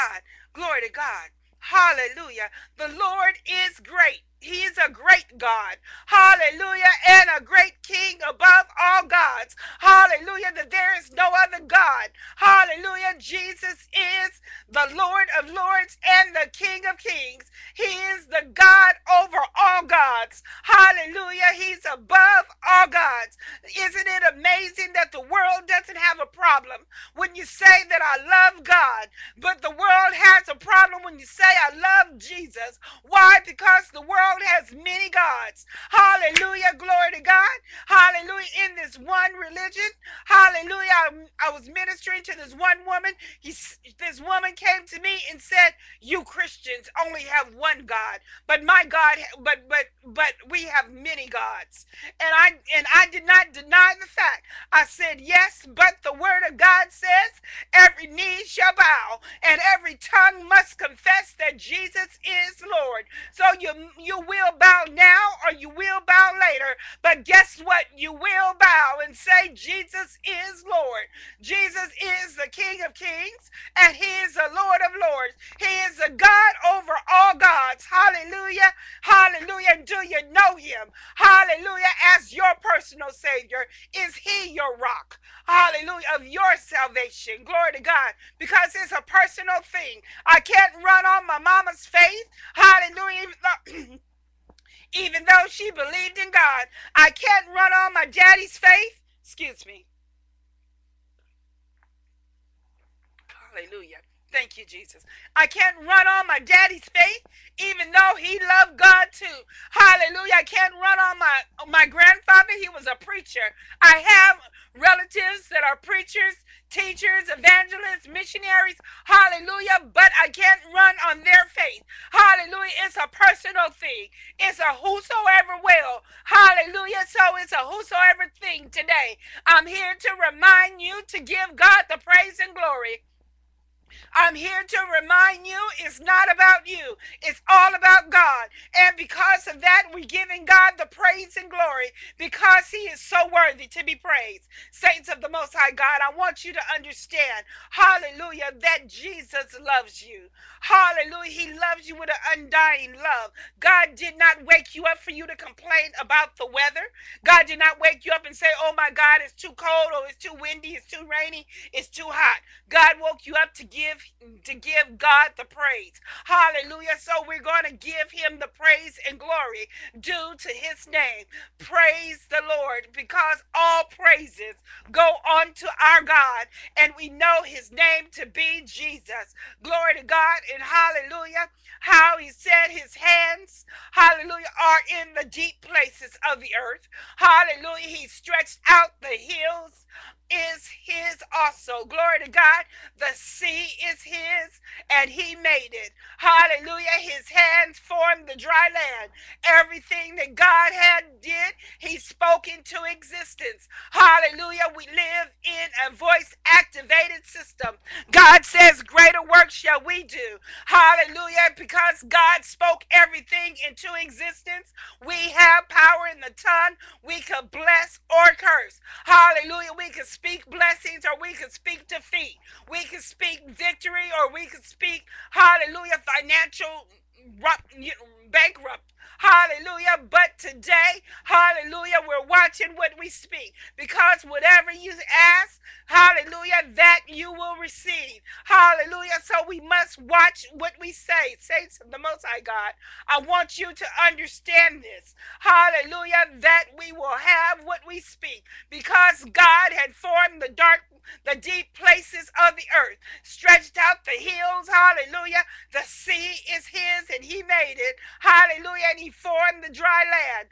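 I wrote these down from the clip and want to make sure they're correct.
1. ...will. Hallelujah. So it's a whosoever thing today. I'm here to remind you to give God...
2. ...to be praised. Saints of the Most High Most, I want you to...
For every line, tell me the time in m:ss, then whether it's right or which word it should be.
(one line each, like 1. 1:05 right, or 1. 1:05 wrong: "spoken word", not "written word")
1. 2:05 right
2. 2:23 wrong: "God", not "Most".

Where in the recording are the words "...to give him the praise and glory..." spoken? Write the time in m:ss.
2:47.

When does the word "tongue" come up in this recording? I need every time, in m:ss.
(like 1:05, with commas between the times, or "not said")
0:59, 3:36.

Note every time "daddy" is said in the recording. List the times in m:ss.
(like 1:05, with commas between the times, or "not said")
1:38, 1:46.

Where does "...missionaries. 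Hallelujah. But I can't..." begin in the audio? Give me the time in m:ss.
1:58.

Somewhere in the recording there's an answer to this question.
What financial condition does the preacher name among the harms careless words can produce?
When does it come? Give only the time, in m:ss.
3:46.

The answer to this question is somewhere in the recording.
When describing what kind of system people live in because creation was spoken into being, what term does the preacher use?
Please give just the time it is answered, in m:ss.
3:25.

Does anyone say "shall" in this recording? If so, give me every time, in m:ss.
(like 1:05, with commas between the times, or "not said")
0:58, 3:29.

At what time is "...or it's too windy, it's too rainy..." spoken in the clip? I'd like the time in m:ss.
2:39.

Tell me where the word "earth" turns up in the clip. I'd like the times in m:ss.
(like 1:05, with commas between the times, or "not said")
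3:06, 4:12.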